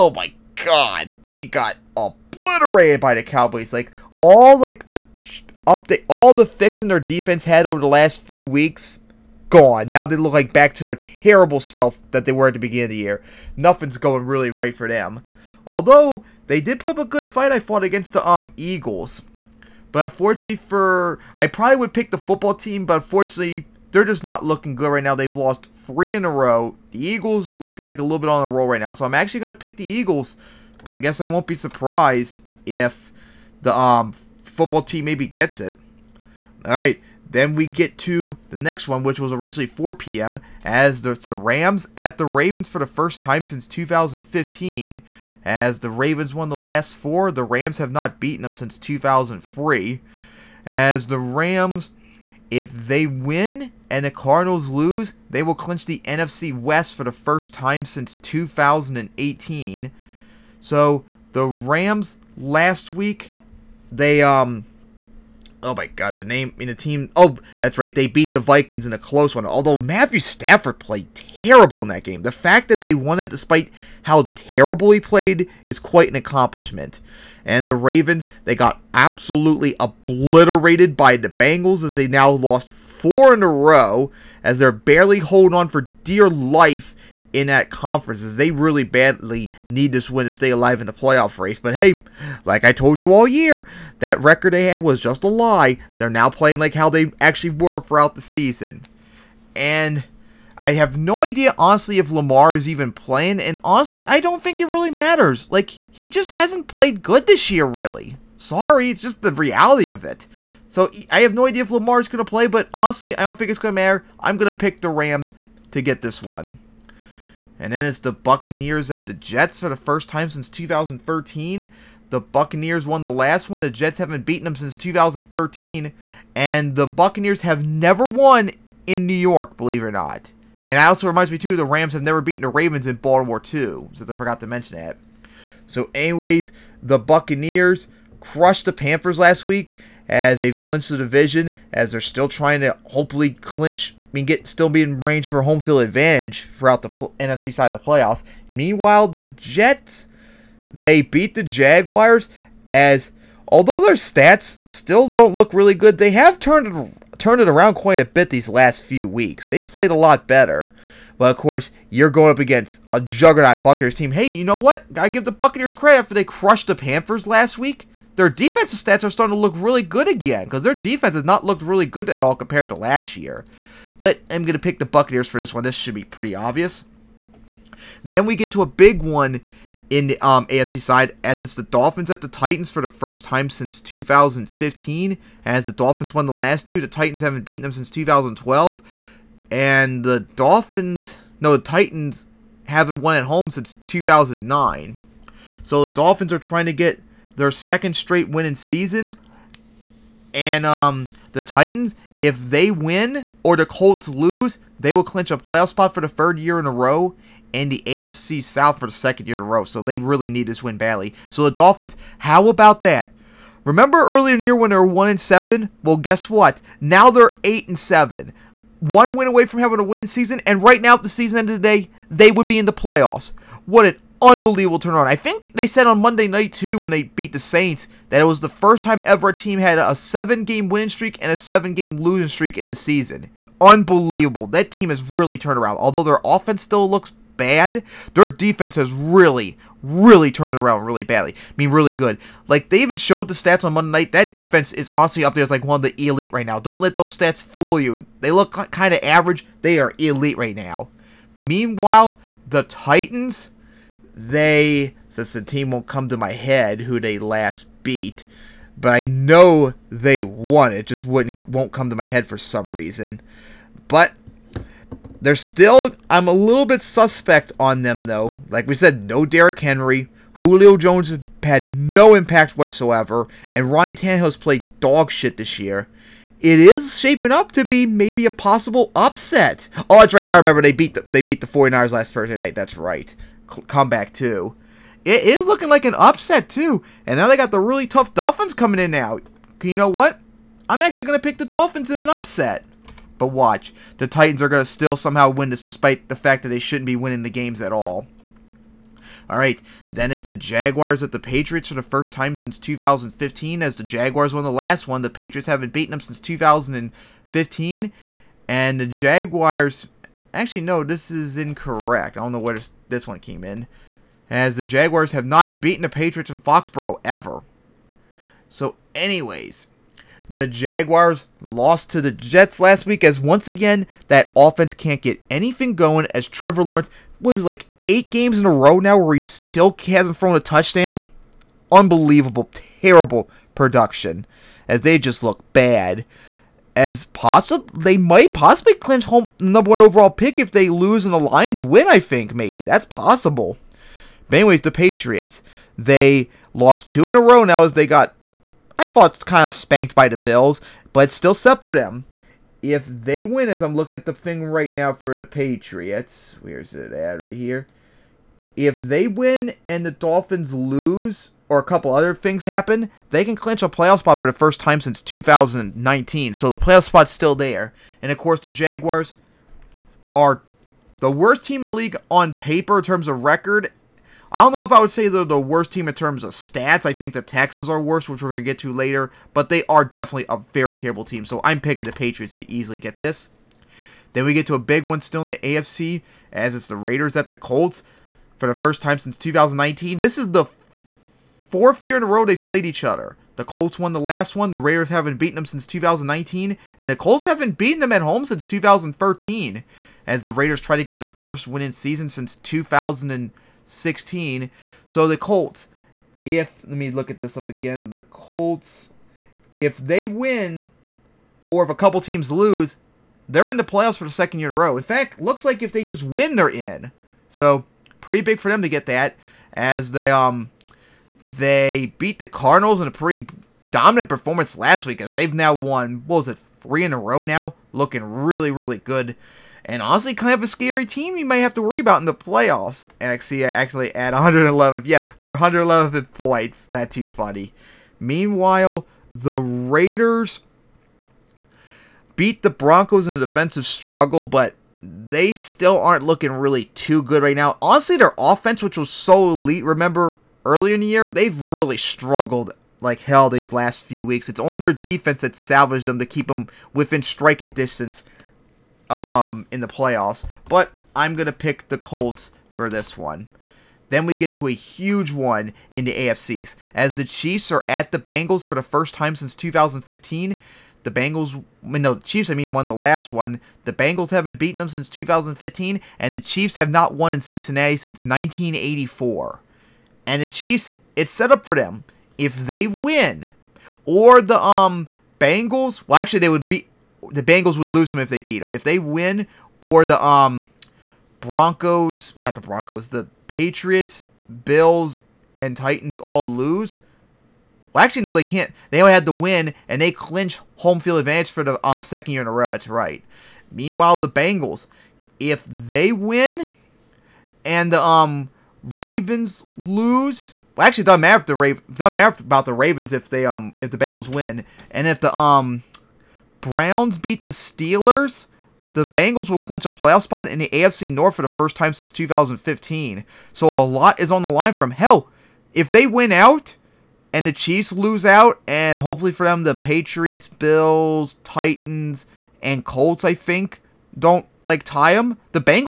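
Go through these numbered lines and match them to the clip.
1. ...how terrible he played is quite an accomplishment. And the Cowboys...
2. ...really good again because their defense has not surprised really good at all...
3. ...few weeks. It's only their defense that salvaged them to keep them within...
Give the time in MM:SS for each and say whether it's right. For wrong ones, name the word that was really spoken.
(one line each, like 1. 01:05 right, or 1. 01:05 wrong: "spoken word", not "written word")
1. 01:14 wrong: "Ravens", not "Cowboys"
2. 02:49 wrong: "looked", not "surprised"
3. 07:33 right.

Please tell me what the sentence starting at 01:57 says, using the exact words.
And then it's the Buccaneers at the Jets for the first time since 2013.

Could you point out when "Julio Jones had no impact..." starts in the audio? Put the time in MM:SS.
04:30.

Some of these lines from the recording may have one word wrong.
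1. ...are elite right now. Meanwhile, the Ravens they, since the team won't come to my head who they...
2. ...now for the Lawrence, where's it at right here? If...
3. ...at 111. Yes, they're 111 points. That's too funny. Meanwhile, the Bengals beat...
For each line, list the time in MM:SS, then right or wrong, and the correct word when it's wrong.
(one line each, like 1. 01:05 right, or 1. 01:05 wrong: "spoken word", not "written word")
1. 04:09 wrong: "Titans", not "Ravens"
2. 05:54 wrong: "Patriots", not "Lawrence"
3. 07:13 wrong: "Raiders", not "Bengals".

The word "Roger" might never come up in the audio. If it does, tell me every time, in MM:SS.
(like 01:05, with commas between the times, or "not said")
not said.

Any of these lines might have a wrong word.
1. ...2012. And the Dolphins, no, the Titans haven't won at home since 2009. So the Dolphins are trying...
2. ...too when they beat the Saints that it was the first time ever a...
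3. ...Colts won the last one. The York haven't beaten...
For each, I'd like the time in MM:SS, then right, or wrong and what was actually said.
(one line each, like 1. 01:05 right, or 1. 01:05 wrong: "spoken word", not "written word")
1. 03:07 right
2. 03:46 right
3. 06:33 wrong: "Raiders", not "York".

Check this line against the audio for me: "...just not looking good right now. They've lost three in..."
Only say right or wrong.
right.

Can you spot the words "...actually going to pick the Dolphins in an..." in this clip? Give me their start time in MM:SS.
04:50.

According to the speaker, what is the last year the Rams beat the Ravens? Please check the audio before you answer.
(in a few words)
2003.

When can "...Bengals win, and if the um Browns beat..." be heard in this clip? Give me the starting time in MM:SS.
08:33.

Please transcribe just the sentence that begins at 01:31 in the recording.
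But hey, like I told you all year, that record they had was just a lie.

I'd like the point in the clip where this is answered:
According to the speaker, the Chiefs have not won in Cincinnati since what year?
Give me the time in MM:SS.
07:58.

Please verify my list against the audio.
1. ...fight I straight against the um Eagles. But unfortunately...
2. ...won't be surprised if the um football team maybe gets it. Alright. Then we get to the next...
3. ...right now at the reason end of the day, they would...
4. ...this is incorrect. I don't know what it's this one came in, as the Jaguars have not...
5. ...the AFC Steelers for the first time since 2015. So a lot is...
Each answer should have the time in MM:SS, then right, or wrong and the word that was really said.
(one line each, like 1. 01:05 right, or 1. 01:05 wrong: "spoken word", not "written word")
1. 00:17 wrong: "fought", not "straight"
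2. 00:31 right
3. 03:40 wrong: "season", not "reason"
4. 05:10 right
5. 08:40 wrong: "North", not "Steelers".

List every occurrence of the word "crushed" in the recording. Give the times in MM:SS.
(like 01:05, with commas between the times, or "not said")
02:18, 02:46.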